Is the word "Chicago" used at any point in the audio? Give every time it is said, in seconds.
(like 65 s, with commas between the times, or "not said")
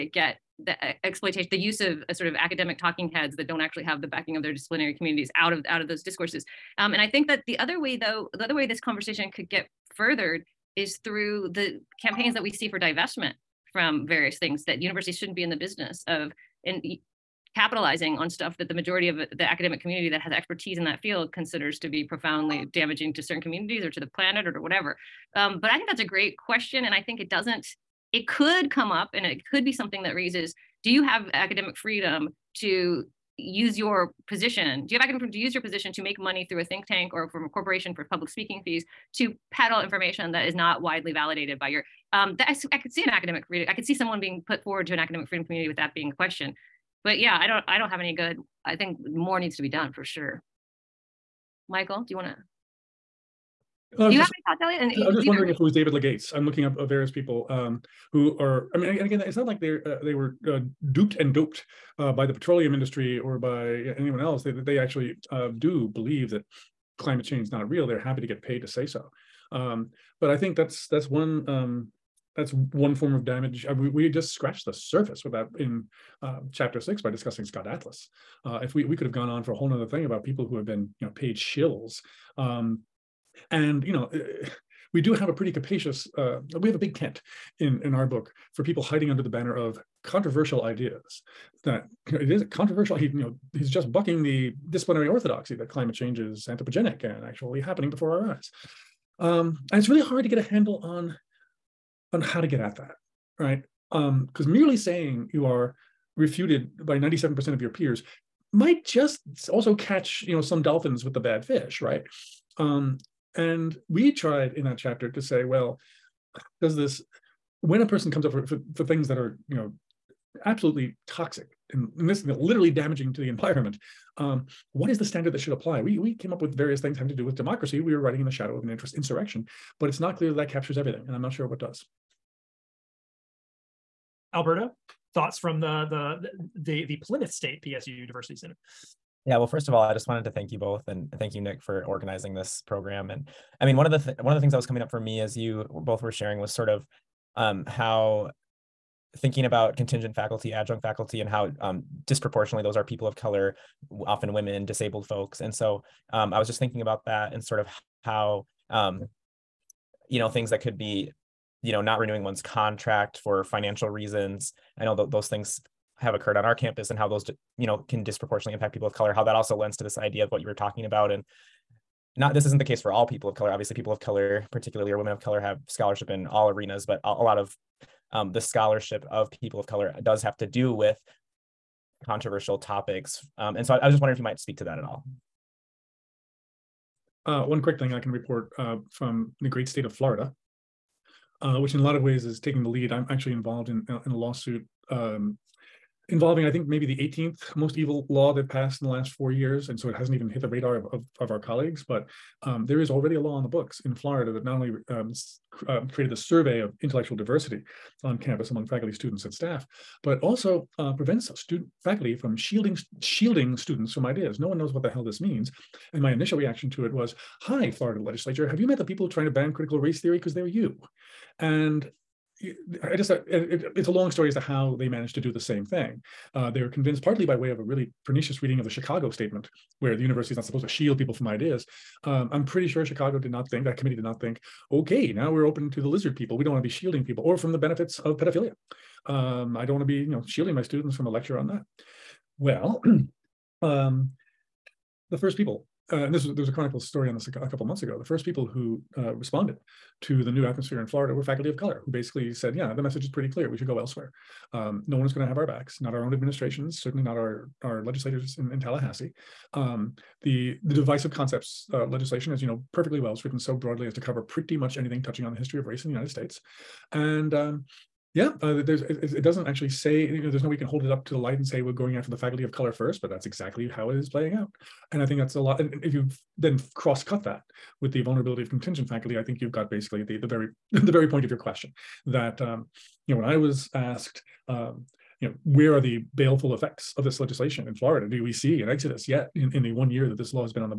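228 s, 232 s.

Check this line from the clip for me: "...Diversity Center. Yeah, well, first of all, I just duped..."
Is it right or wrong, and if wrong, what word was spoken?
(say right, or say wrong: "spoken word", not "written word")
wrong: "wanted", not "duped".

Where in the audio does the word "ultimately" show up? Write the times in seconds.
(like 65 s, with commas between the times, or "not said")
not said.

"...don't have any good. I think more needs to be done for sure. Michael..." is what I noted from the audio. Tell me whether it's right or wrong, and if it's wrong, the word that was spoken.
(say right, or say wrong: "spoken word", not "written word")
right.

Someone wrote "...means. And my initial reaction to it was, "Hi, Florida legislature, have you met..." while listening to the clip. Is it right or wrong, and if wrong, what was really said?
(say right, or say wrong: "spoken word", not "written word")
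right.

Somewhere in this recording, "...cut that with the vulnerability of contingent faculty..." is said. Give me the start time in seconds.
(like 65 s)
277 s.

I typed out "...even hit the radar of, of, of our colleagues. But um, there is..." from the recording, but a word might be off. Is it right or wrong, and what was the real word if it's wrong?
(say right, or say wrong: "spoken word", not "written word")
right.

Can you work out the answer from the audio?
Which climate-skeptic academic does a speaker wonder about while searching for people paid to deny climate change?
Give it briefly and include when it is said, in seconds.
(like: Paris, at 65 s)
David Legates, at 55 s.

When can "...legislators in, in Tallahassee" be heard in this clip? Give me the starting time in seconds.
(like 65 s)
257 s.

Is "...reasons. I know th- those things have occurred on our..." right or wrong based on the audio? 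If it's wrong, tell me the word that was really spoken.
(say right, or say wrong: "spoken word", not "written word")
right.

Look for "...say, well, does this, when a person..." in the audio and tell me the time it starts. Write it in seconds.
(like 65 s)
115 s.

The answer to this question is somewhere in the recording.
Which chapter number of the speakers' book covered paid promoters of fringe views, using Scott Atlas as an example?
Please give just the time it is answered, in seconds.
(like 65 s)
76 s.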